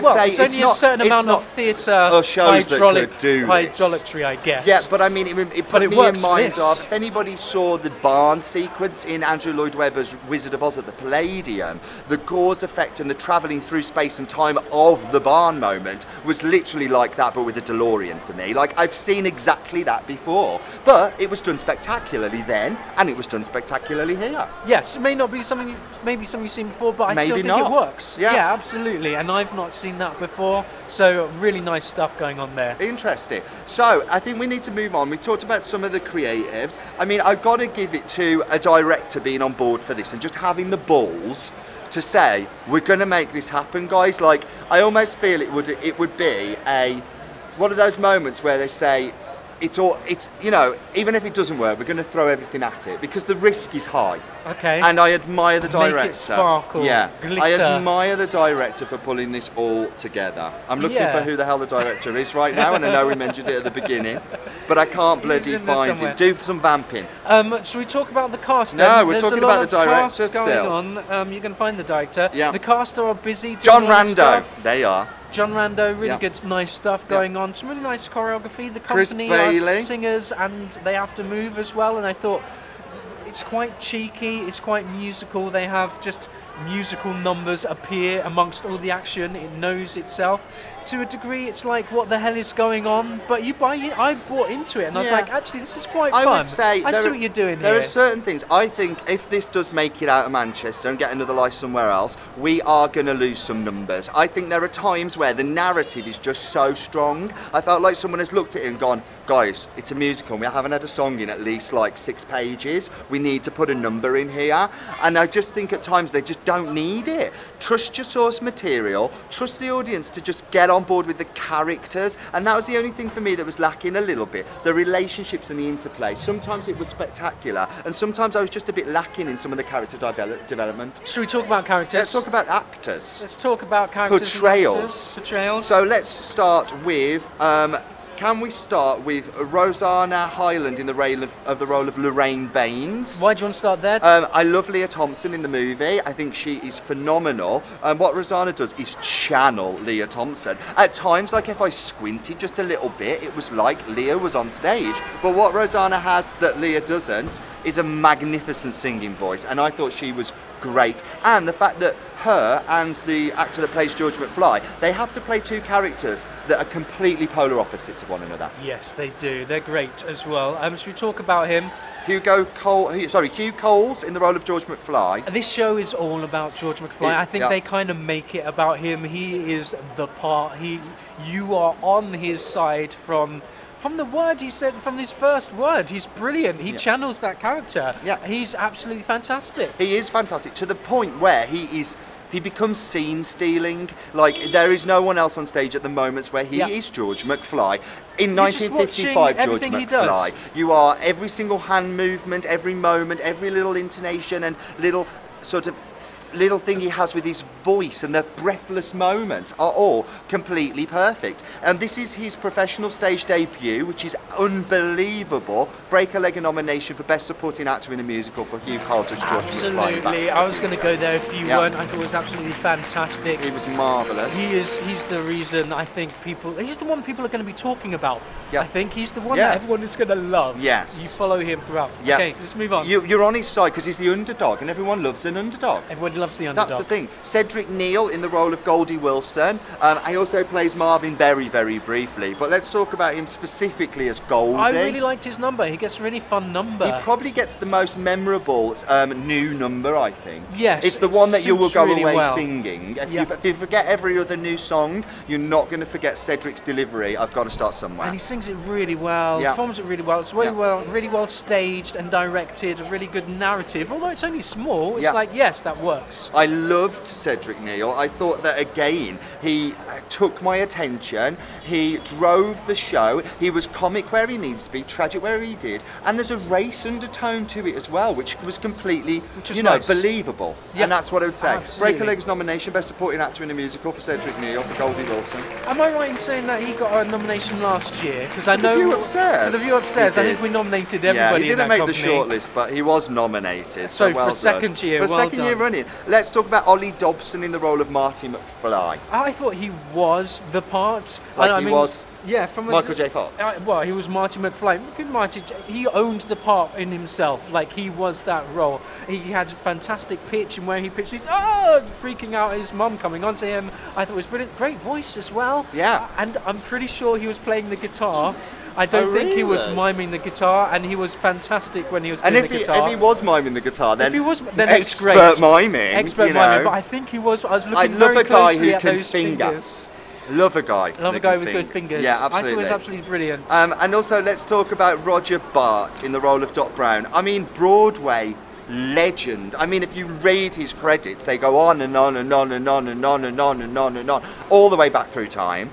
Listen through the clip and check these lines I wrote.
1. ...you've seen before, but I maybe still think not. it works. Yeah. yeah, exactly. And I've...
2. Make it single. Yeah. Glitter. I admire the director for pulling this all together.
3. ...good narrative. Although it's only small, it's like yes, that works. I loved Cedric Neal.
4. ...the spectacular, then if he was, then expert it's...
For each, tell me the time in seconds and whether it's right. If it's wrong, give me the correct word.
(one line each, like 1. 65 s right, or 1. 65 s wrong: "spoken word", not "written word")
1. 26 s wrong: "absolutely", not "exactly"
2. 55 s wrong: "sparkle", not "single"
3. 263 s right
4. 323 s wrong: "guitar", not "spectacular".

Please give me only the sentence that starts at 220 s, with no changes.
I was going to go there if you weren't.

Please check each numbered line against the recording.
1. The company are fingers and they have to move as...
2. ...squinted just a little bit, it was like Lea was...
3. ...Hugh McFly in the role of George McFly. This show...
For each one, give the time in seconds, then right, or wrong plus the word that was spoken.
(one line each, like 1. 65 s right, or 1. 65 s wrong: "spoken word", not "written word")
1. 78 s wrong: "singers", not "fingers"
2. 151 s right
3. 173 s wrong: "Coles", not "McFly".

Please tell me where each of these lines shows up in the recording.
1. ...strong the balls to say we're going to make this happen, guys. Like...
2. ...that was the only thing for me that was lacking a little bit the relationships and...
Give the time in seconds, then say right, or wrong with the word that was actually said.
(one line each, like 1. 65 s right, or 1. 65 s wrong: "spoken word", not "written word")
1. 40 s wrong: "having", not "strong"
2. 122 s right.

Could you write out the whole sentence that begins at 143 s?
Um, I love Lea Thompson in the movie.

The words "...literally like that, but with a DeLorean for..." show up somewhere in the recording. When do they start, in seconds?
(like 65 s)
16 s.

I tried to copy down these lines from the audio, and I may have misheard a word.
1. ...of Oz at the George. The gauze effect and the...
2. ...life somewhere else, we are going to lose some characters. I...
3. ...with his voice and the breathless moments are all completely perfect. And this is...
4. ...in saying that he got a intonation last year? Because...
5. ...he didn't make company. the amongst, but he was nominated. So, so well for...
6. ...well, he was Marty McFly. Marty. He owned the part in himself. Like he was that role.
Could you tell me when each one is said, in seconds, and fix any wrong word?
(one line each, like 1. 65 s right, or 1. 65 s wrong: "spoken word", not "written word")
1. 10 s wrong: "Palladium", not "George"
2. 101 s wrong: "numbers", not "characters"
3. 207 s right
4. 286 s wrong: "nomination", not "intonation"
5. 291 s wrong: "shortlist", not "amongst"
6. 303 s right.